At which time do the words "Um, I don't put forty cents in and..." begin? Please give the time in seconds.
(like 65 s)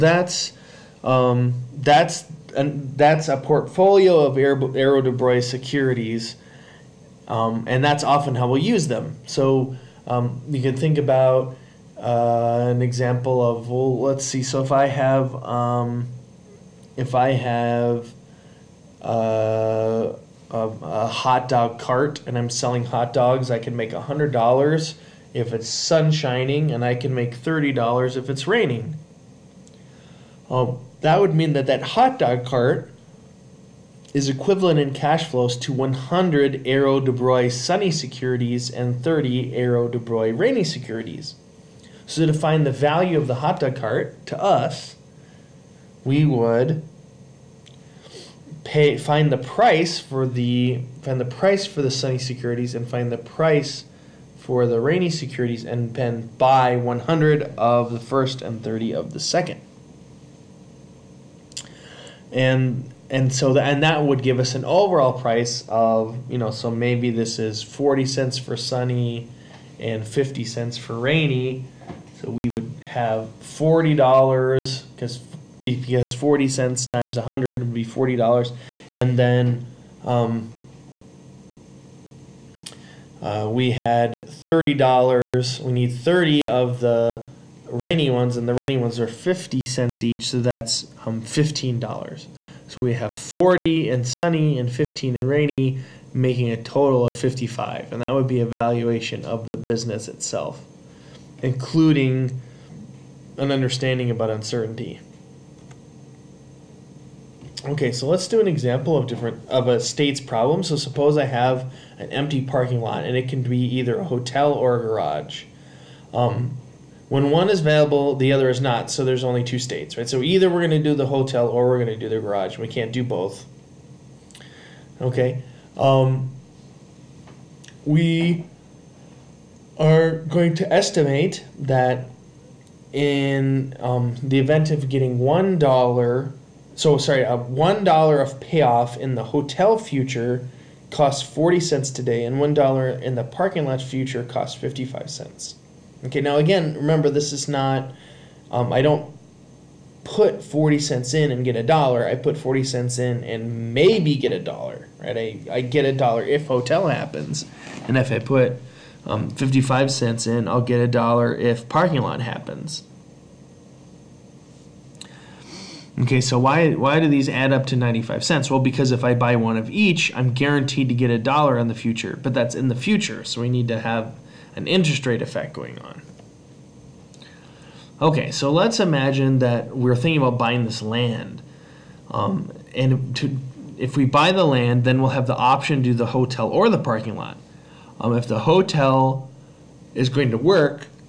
148 s.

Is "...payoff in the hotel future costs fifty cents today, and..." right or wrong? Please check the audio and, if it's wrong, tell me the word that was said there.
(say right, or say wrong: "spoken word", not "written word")
wrong: "forty", not "fifty".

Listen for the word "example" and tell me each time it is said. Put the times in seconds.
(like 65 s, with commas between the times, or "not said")
12 s, 108 s.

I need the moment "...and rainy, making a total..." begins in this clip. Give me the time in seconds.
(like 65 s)
95 s.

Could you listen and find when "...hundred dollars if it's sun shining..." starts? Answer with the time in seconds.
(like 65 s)
23 s.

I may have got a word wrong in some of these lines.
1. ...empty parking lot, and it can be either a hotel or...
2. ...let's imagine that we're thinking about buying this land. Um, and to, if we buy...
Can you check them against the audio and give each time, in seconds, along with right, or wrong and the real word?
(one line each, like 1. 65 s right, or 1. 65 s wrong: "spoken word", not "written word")
1. 112 s right
2. 178 s right.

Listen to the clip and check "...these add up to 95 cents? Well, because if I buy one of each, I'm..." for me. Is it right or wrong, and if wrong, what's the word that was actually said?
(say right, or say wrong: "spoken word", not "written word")
right.